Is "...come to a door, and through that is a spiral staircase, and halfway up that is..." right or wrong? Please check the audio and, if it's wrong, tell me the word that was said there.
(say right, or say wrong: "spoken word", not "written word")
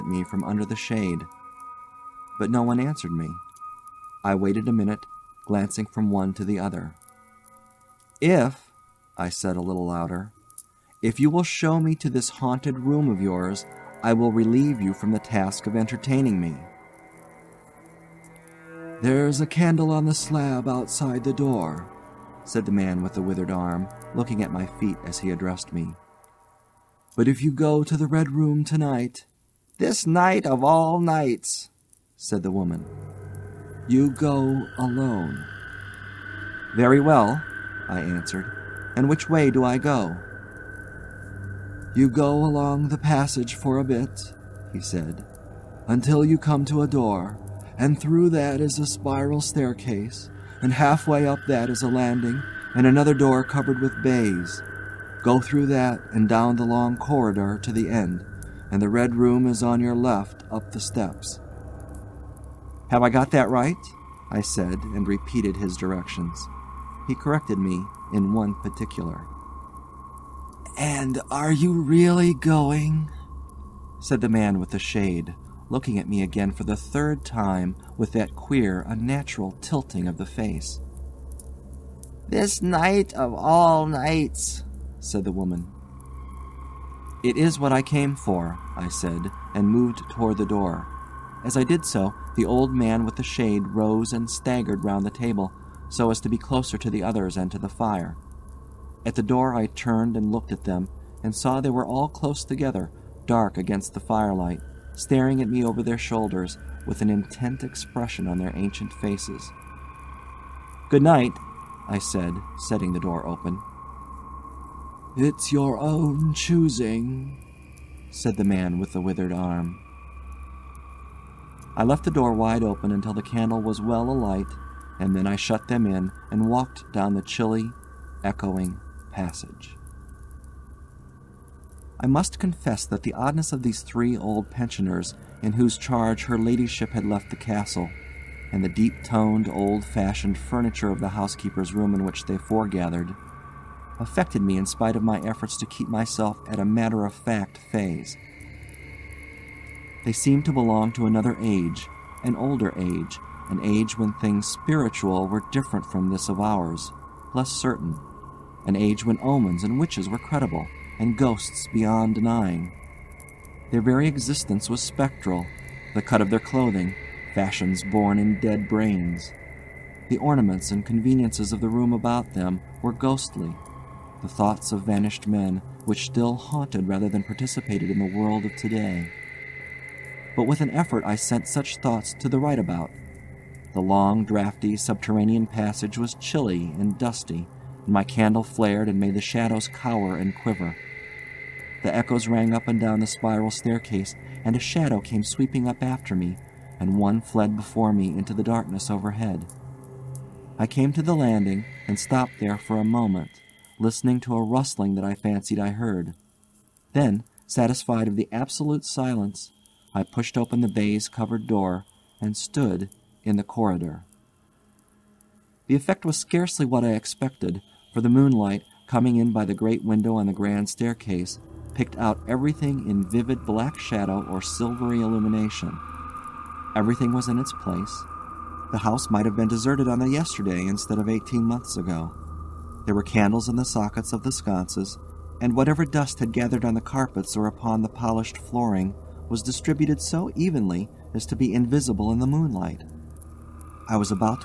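right.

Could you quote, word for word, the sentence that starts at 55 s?
Go through that and down the long corridor to the end, and the red room is on your left up the steps.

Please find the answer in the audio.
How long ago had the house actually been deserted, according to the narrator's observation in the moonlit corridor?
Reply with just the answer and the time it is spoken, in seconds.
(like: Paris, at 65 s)
18 months, at 231 s.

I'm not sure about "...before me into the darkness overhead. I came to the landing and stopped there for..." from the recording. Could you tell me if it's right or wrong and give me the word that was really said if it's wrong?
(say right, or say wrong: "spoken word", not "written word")
right.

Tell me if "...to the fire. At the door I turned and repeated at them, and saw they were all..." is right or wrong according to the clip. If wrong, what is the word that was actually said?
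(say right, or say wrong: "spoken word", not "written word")
wrong: "looked", not "repeated".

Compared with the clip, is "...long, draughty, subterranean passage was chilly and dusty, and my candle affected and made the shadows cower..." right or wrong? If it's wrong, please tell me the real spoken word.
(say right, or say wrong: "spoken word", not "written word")
wrong: "flared", not "affected".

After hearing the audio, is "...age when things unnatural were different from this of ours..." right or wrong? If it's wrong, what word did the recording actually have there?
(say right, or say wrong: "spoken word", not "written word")
wrong: "spiritual", not "unnatural".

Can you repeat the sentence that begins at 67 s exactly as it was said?
He corrected me in one particular.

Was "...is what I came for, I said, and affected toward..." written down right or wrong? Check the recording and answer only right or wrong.
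wrong.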